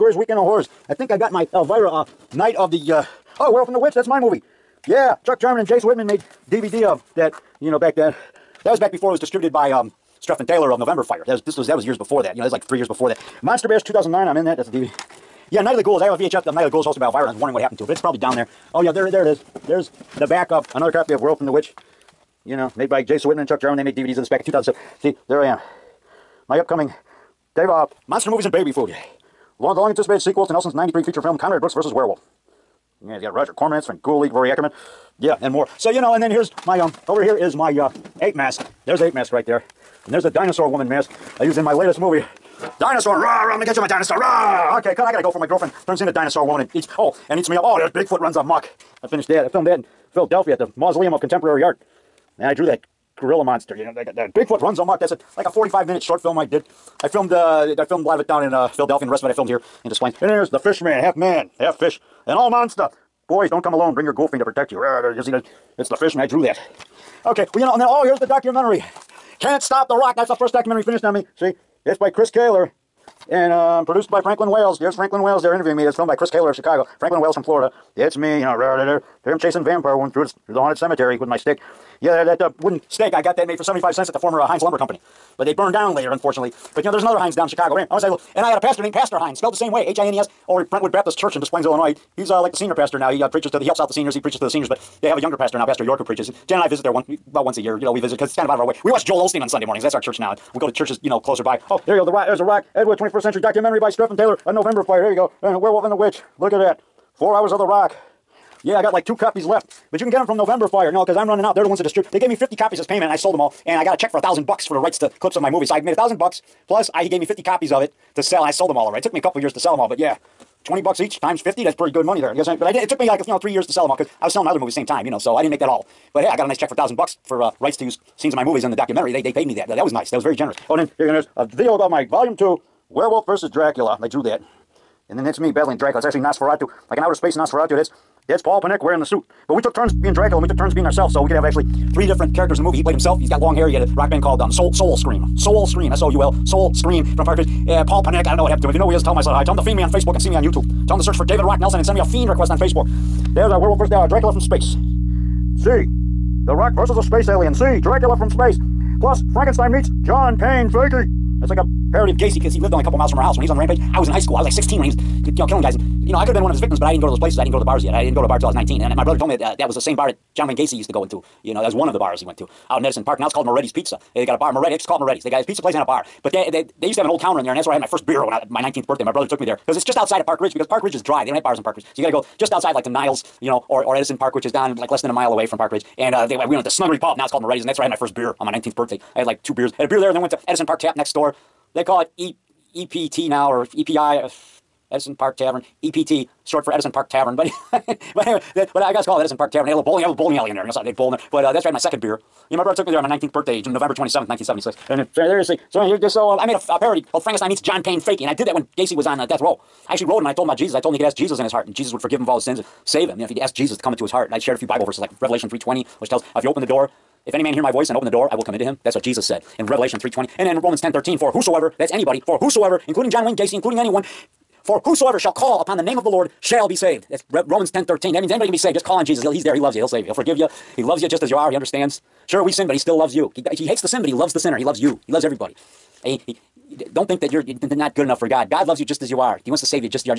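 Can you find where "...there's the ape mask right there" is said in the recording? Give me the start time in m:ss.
0:38.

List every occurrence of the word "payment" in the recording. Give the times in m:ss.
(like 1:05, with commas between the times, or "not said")
1:52.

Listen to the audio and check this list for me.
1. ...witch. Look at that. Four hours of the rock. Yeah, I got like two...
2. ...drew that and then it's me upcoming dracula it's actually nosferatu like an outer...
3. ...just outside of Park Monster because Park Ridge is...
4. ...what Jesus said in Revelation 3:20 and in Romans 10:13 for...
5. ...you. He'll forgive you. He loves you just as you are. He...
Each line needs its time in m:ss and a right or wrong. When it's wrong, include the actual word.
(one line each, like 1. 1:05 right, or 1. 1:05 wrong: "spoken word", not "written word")
1. 1:45 right
2. 2:14 wrong: "battling", not "upcoming"
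3. 2:59 wrong: "Ridge", not "Monster"
4. 3:38 right
5. 3:50 right.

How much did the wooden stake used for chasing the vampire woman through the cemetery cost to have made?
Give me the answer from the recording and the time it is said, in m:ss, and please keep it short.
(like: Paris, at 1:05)
75 cents, at 1:23.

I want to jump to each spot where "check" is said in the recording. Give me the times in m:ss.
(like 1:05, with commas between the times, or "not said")
1:53, 2:06.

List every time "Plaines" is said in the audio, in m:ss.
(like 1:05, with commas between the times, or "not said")
0:59, 1:31.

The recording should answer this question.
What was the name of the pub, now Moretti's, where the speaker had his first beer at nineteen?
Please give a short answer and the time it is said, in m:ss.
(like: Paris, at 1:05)
Snuggery Pub, at 3:06.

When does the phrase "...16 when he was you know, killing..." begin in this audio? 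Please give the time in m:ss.
2:44.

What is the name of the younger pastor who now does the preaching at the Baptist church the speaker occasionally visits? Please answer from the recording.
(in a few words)
Pastor York.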